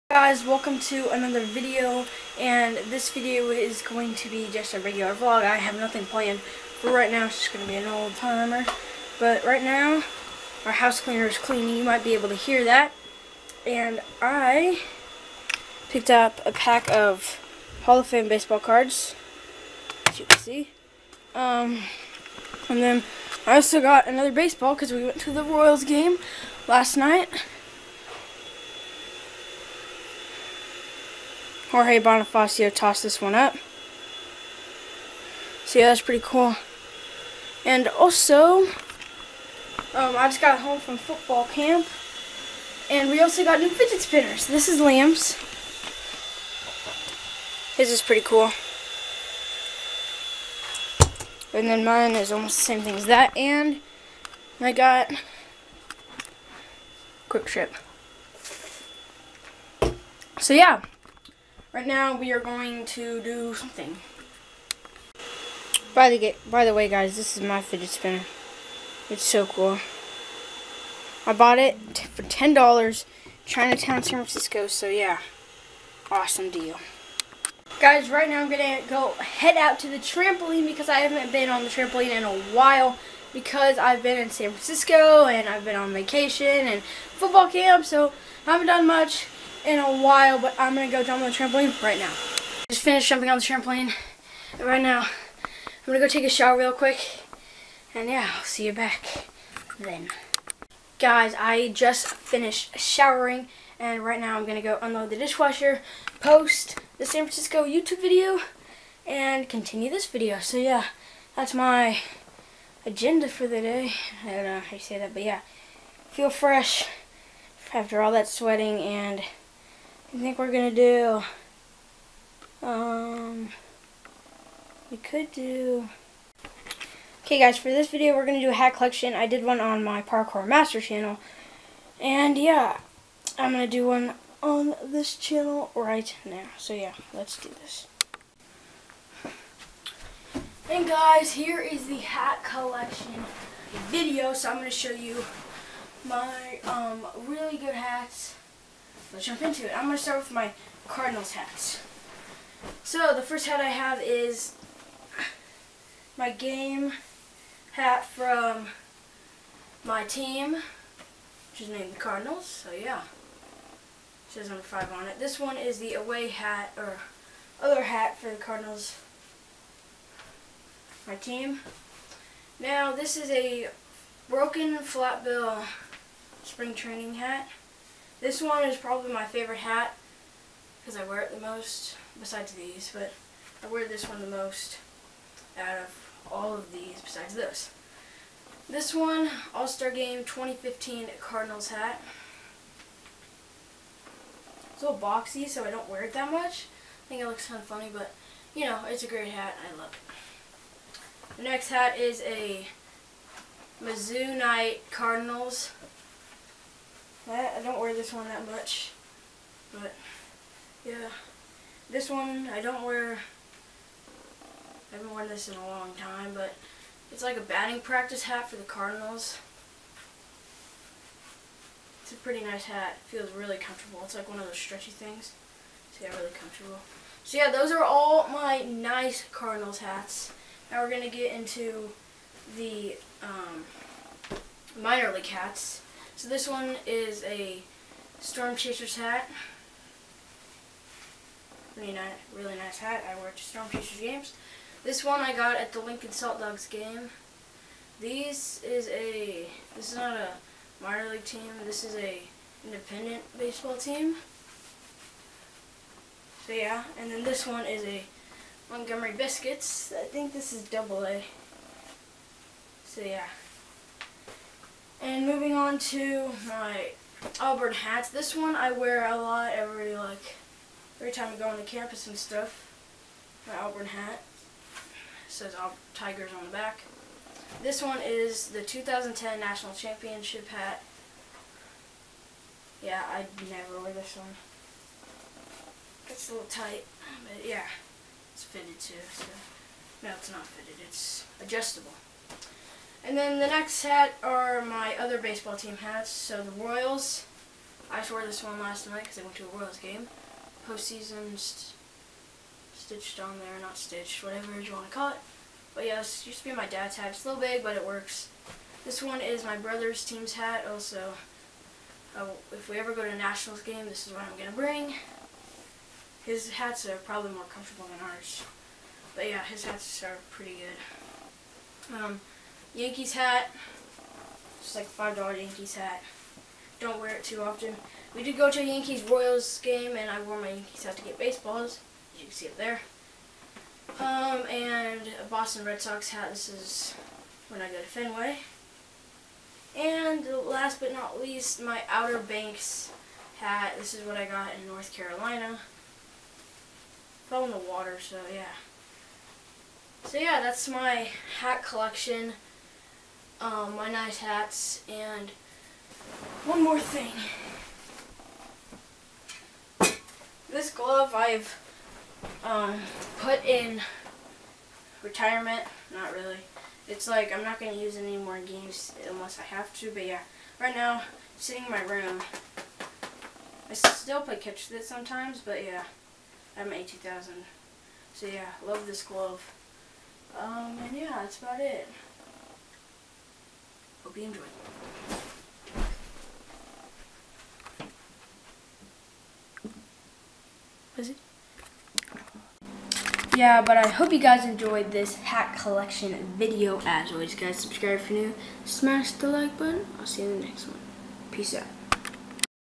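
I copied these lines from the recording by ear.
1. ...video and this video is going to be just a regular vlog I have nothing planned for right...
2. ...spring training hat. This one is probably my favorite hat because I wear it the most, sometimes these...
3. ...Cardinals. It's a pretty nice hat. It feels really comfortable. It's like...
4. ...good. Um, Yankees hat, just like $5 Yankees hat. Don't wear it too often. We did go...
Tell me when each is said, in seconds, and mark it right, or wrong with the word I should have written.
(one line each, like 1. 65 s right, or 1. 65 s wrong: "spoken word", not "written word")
1. 1 s right
2. 176 s wrong: "besides", not "sometimes"
3. 218 s right
4. 321 s right.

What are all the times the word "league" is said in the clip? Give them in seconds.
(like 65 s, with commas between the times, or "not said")
235 s, 251 s.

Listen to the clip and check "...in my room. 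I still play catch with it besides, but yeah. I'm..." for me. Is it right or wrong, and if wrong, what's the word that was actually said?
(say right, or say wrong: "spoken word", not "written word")
wrong: "sometimes", not "besides".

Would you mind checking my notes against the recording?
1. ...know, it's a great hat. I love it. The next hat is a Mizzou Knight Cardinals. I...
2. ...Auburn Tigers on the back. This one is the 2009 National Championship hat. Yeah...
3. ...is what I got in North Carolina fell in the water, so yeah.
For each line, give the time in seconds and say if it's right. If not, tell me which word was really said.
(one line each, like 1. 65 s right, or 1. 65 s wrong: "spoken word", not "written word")
1. 198 s right
2. 275 s wrong: "2010", not "2009"
3. 343 s right.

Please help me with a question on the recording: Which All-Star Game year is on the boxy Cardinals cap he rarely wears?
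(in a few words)
2015.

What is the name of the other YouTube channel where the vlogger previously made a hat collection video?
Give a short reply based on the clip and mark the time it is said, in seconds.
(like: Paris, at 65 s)
Parkour Master, at 130 s.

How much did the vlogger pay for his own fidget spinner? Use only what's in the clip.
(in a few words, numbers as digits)
$10.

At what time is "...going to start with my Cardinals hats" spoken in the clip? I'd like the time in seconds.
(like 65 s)
149 s.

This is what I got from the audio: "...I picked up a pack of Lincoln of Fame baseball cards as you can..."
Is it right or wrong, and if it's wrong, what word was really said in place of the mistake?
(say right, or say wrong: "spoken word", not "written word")
wrong: "Hall", not "Lincoln".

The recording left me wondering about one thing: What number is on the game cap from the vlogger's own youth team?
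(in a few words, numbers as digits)
5.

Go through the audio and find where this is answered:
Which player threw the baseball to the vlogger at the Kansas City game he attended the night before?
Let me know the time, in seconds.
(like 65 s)
31 s.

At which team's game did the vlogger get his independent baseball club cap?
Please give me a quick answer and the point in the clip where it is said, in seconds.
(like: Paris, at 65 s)
Lincoln Saltdogs, at 245 s.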